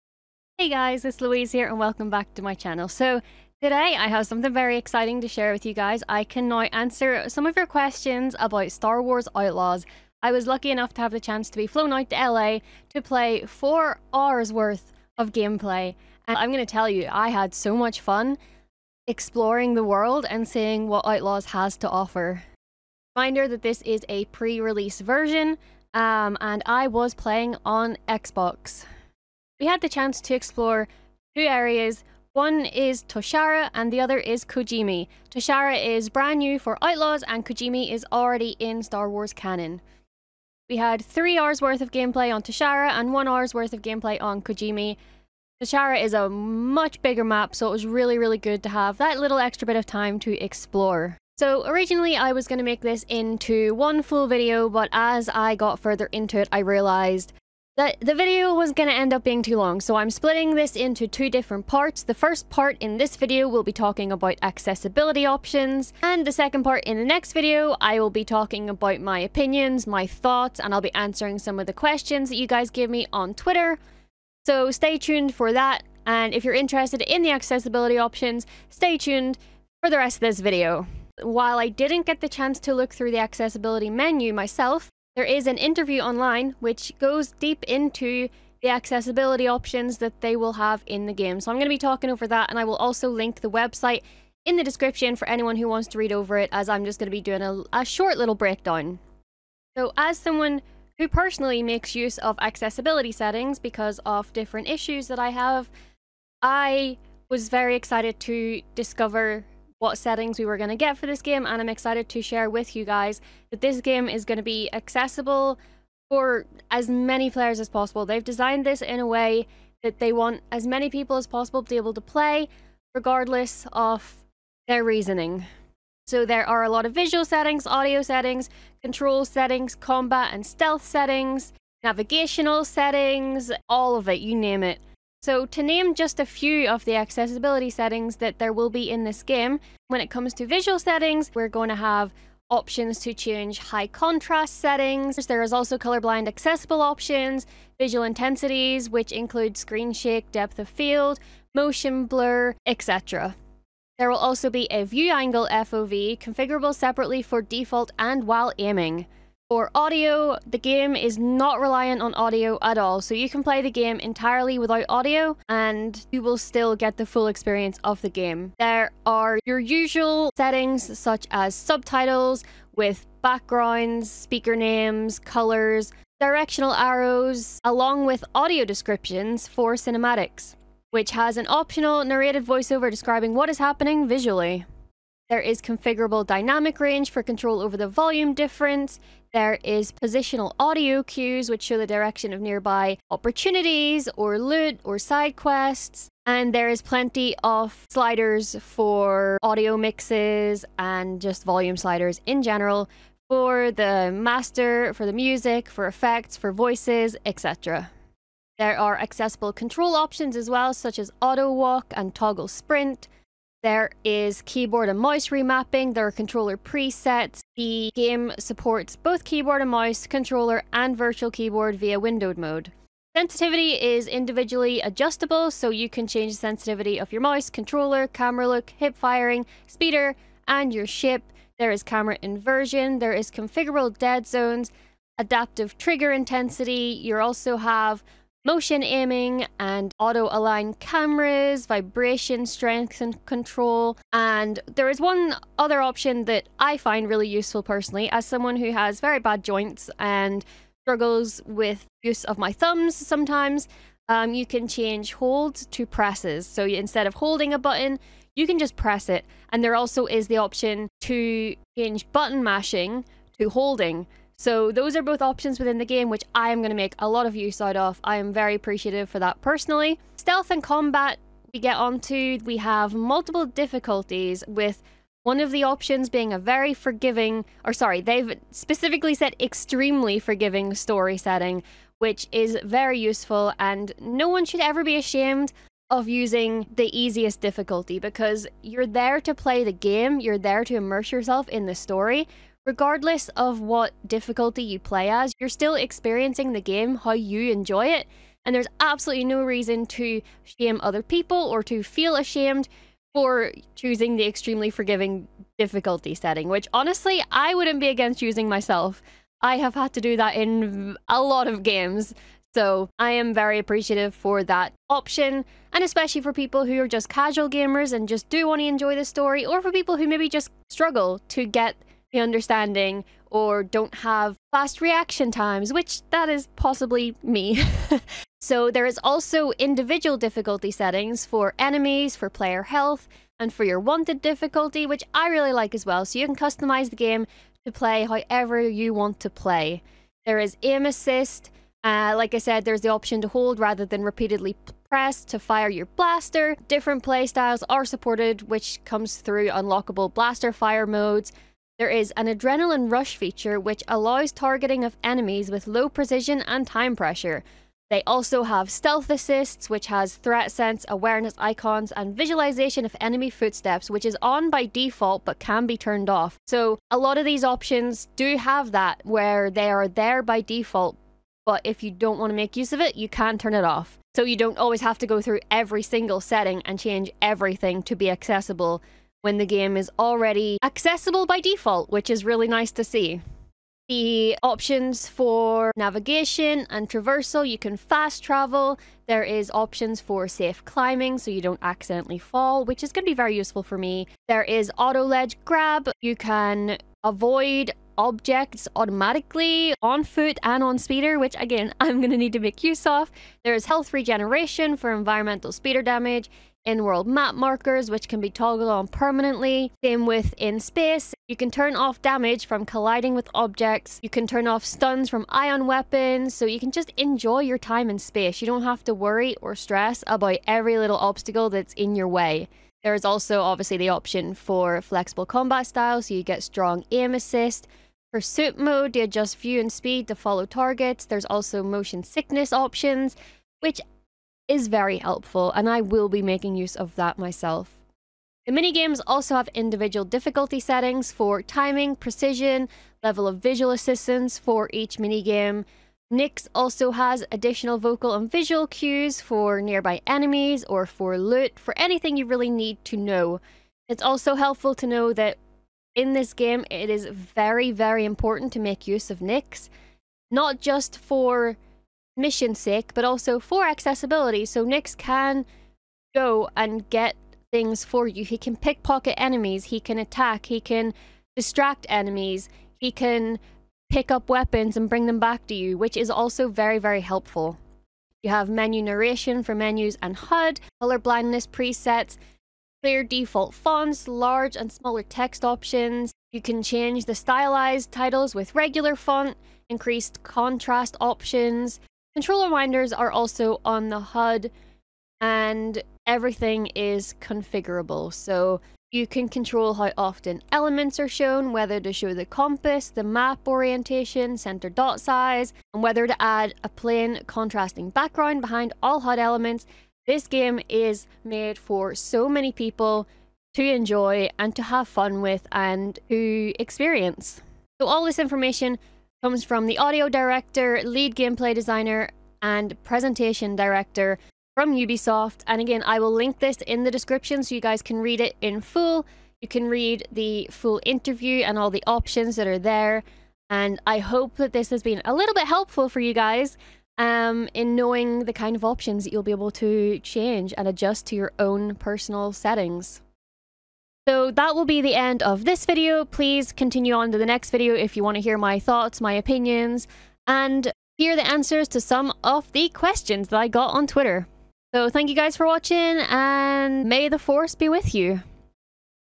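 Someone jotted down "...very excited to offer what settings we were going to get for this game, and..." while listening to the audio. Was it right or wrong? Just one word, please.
wrong.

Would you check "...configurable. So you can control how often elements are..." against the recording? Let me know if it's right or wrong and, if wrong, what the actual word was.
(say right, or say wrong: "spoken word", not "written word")
right.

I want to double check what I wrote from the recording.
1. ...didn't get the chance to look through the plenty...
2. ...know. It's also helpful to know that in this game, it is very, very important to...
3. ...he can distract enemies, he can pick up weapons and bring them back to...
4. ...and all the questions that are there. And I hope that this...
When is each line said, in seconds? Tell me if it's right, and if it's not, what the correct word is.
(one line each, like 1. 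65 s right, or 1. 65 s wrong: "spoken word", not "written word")
1. 81 s wrong: "accessibility", not "plenty"
2. 452 s right
3. 470 s right
4. 531 s wrong: "options", not "questions".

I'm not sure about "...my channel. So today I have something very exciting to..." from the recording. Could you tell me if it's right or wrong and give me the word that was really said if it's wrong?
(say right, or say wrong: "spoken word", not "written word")
right.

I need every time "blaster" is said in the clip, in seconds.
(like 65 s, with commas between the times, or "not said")
345 s, 350 s.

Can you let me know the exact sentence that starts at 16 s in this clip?
And I'm going to tell you, I had so much fun exploring the world and seeing what Outlaws has to offer.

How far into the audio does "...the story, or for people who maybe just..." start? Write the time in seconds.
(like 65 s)
318 s.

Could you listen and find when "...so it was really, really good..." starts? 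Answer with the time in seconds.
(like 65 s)
47 s.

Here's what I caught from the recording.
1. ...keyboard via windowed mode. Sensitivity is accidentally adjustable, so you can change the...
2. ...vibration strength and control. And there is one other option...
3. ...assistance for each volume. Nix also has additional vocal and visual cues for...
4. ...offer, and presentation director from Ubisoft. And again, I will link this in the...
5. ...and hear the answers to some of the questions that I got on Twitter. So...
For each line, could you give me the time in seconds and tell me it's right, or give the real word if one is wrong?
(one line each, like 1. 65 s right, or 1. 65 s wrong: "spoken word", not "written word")
1. 221 s wrong: "individually", not "accidentally"
2. 241 s right
3. 443 s wrong: "minigame", not "volume"
4. 521 s wrong: "designer", not "offer"
5. 550 s right.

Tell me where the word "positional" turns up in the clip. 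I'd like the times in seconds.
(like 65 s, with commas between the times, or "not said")
189 s.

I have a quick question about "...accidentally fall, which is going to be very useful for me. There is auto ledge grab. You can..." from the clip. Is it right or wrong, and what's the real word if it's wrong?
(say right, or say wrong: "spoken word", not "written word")
right.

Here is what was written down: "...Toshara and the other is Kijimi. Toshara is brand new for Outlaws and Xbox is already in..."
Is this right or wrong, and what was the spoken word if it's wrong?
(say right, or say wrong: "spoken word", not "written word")
wrong: "Kijimi", not "Xbox".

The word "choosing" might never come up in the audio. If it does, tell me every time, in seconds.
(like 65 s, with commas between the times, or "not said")
303 s.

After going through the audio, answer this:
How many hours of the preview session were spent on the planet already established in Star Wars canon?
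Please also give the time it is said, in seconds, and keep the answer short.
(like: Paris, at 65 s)
1, at 43 s.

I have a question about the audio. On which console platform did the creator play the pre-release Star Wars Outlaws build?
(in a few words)
Xbox.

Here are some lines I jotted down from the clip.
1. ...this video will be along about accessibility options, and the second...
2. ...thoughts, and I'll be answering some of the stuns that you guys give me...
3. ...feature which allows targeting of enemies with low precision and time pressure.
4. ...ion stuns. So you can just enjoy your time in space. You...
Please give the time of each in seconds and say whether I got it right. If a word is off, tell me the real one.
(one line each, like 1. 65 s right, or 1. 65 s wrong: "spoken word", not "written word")
1. 62 s wrong: "talking", not "along"
2. 70 s wrong: "questions", not "stuns"
3. 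353 s right
4. 415 s wrong: "weapons", not "stuns".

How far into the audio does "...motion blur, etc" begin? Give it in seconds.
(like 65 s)
151 s.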